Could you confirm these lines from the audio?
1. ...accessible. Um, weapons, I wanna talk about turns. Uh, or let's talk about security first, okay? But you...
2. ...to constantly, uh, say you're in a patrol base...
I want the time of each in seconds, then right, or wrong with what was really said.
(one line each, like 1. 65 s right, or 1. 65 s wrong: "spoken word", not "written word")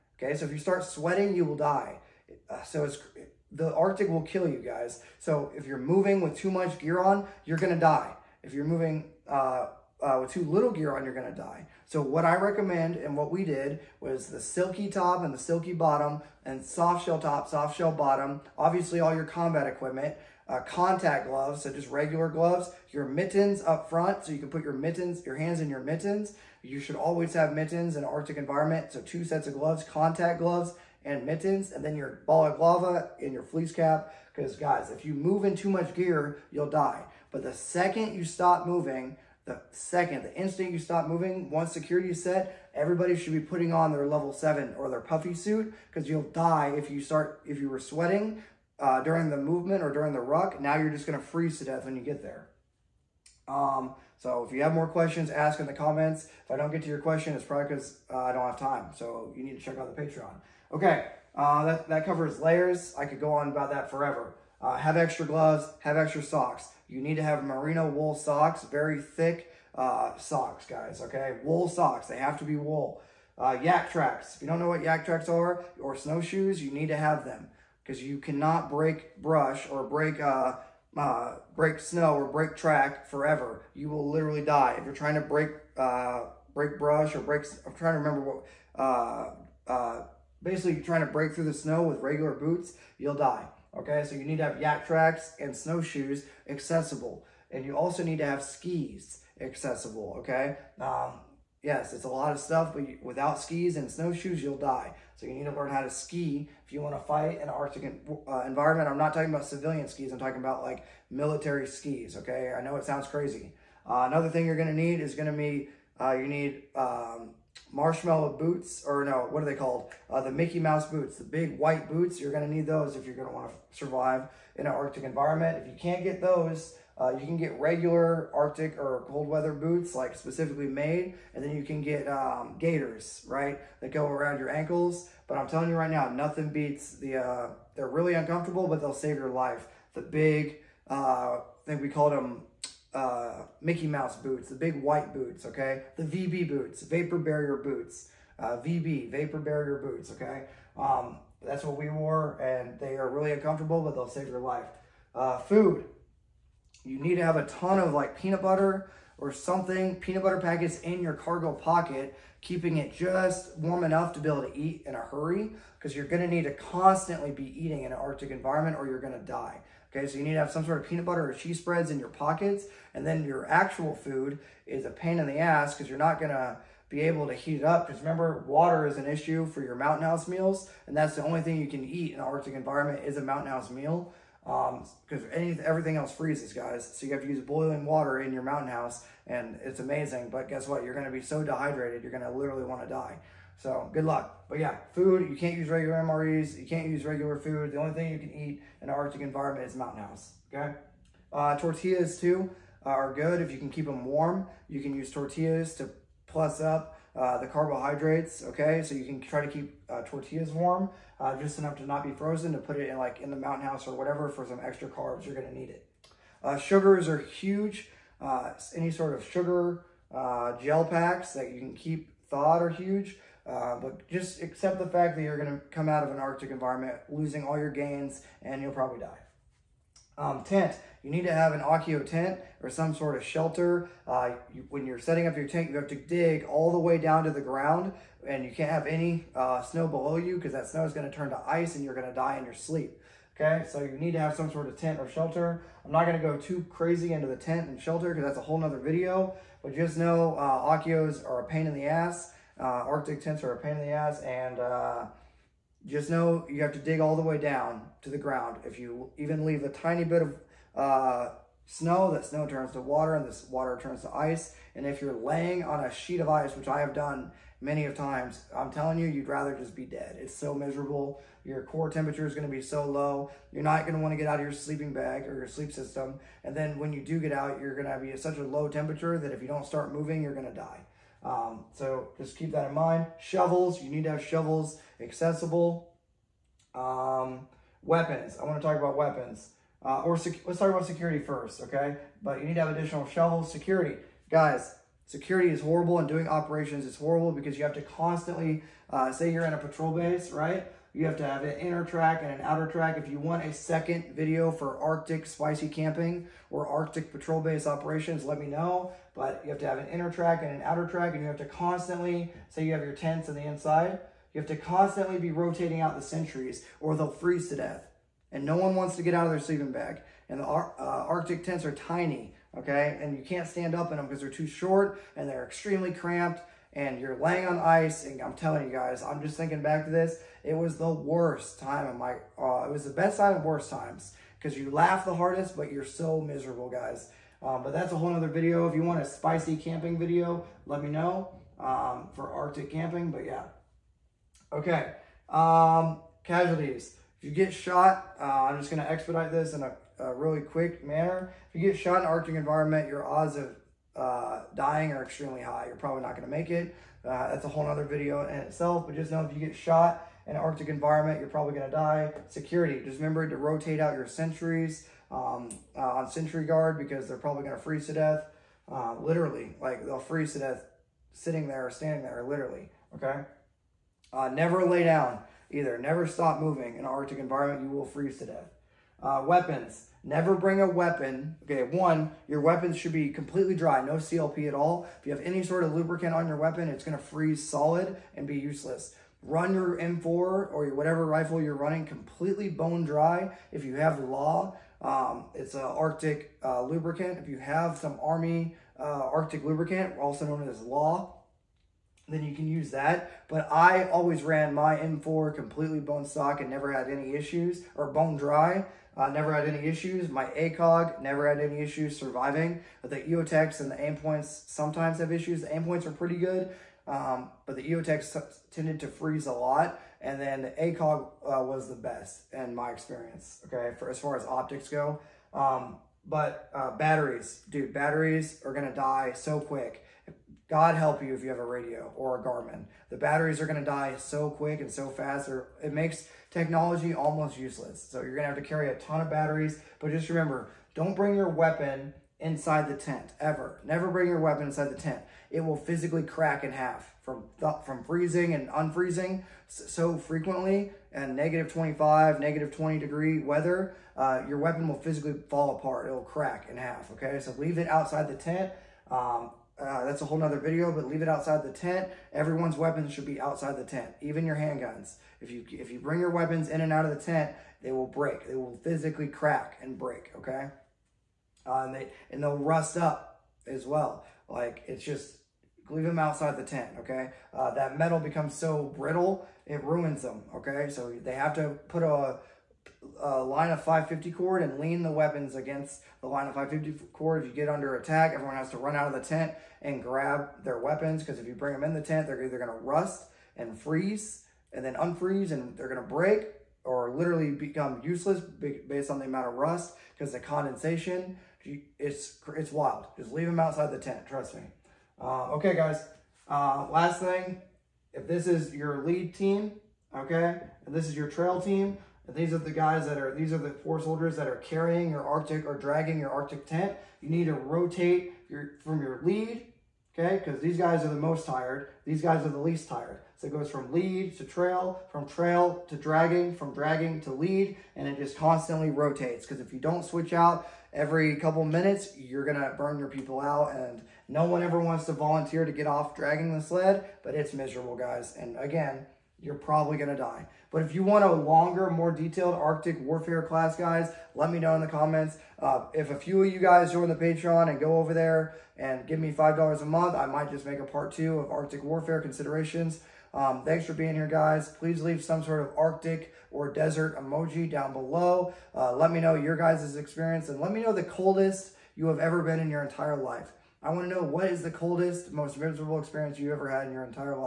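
1. 284 s wrong: "weapons", not "turns"
2. 297 s right.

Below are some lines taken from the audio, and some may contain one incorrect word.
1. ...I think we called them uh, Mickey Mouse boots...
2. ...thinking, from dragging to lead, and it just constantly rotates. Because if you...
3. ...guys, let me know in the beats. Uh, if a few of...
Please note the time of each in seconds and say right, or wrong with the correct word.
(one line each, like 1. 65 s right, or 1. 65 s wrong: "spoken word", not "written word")
1. 140 s right
2. 525 s wrong: "dragging", not "thinking"
3. 543 s wrong: "comments", not "beats".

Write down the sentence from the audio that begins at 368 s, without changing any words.
Uh, literally, like they'll freeze to death sitting there or standing there, literally.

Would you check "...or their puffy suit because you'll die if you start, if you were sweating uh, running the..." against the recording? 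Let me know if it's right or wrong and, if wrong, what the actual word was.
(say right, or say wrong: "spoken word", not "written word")
wrong: "during", not "running".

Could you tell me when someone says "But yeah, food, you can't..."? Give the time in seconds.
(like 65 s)
194 s.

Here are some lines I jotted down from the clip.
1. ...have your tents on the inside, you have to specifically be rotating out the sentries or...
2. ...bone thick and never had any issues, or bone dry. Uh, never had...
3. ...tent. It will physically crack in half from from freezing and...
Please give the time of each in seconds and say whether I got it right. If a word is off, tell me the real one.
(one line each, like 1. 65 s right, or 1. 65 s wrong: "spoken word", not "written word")
1. 312 s wrong: "constantly", not "specifically"
2. 405 s wrong: "stock", not "thick"
3. 444 s right.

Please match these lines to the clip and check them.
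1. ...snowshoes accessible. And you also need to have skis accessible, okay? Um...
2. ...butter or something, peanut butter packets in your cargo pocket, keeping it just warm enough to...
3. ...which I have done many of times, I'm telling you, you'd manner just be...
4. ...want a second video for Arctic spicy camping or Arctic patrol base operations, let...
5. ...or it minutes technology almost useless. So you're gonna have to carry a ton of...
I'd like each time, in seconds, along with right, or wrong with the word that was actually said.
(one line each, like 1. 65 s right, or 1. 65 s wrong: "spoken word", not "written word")
1. 95 s right
2. 158 s right
3. 266 s wrong: "rather", not "manner"
4. 303 s right
5. 435 s wrong: "makes", not "minutes".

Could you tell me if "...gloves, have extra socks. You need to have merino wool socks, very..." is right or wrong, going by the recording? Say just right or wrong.
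right.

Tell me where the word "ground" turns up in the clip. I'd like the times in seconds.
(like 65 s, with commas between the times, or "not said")
237 s, 258 s.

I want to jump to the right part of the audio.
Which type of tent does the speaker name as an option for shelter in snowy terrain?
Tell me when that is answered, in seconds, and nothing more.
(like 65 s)
231 s.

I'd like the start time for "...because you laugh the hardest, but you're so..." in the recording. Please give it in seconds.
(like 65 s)
334 s.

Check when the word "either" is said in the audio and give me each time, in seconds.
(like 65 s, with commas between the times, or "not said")
375 s, 492 s.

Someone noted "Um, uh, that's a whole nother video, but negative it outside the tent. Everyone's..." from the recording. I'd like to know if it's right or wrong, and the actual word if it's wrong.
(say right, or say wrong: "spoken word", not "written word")
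wrong: "leave", not "negative".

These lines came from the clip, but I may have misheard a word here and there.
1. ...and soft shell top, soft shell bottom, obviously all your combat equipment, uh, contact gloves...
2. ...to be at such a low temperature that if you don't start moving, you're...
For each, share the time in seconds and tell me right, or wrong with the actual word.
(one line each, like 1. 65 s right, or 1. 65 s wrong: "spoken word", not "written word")
1. 16 s right
2. 277 s right.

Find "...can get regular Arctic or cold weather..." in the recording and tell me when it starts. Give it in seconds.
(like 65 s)
127 s.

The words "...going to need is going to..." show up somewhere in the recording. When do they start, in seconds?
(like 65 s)
114 s.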